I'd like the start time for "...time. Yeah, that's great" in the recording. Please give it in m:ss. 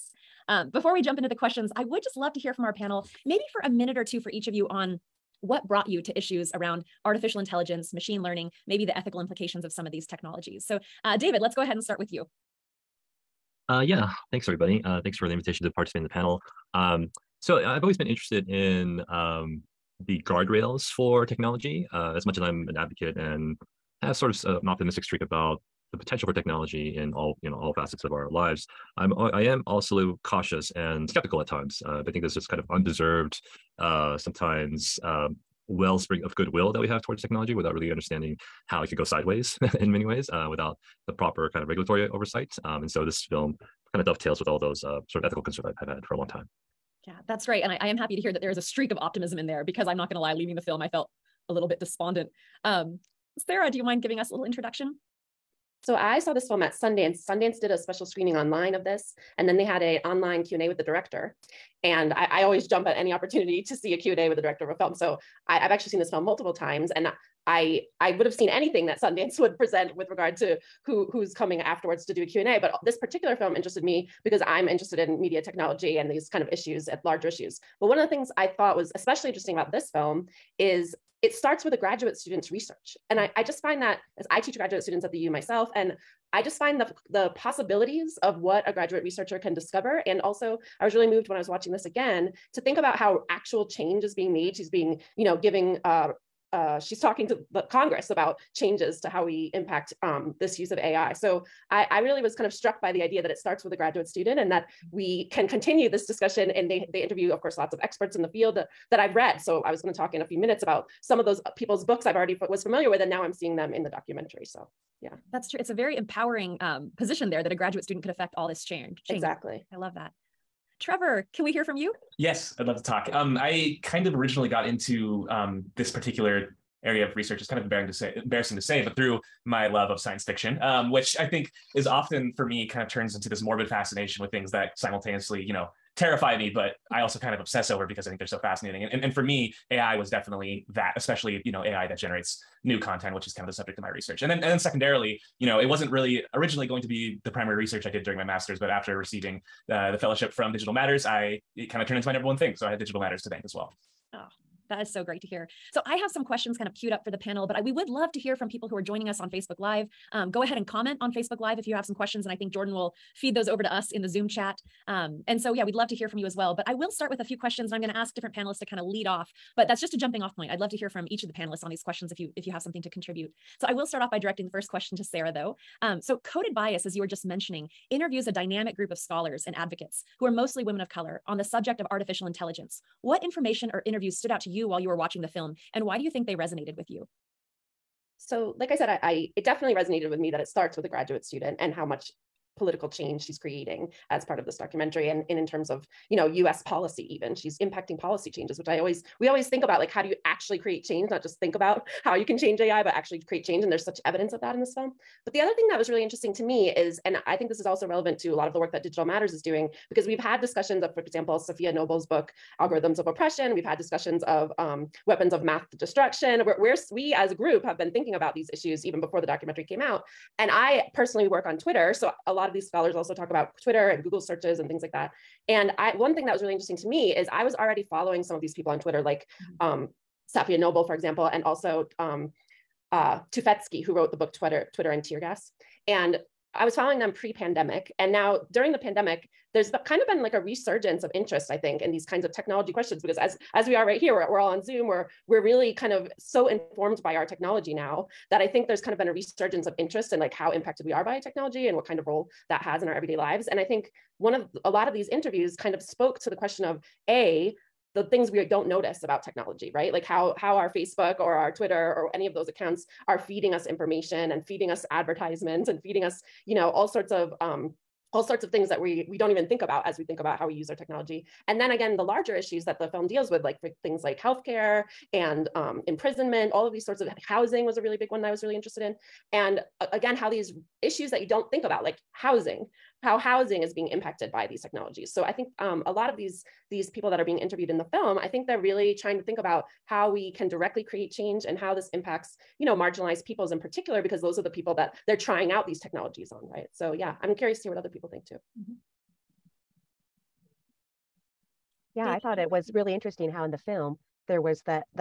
0:46.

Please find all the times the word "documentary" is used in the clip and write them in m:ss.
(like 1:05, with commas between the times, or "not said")
1:53, 3:14, 3:39.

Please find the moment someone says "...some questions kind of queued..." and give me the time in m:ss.
2:36.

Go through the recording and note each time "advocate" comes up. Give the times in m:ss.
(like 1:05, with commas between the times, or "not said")
0:22, 2:59.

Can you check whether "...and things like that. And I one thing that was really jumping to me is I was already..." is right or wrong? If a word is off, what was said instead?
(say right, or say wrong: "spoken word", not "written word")
wrong: "interesting", not "jumping".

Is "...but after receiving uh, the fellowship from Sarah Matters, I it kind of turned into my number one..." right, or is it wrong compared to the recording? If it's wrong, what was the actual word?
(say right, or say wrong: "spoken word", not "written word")
wrong: "Digital", not "Sarah".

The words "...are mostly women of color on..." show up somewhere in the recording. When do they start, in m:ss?
3:00.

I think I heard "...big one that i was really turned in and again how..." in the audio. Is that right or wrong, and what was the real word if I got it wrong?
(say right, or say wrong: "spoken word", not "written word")
wrong: "interested", not "turned".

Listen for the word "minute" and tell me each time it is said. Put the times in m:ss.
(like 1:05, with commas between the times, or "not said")
0:03, 1:50.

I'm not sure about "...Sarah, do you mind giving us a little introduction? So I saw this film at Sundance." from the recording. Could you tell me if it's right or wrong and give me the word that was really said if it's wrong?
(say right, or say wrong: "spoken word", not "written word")
right.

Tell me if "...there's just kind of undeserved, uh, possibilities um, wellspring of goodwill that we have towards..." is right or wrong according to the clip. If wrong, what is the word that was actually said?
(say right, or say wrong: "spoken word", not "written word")
wrong: "sometimes", not "possibilities".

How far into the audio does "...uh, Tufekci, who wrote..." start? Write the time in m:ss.
3:52.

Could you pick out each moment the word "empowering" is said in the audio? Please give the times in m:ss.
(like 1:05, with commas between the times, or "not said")
1:55.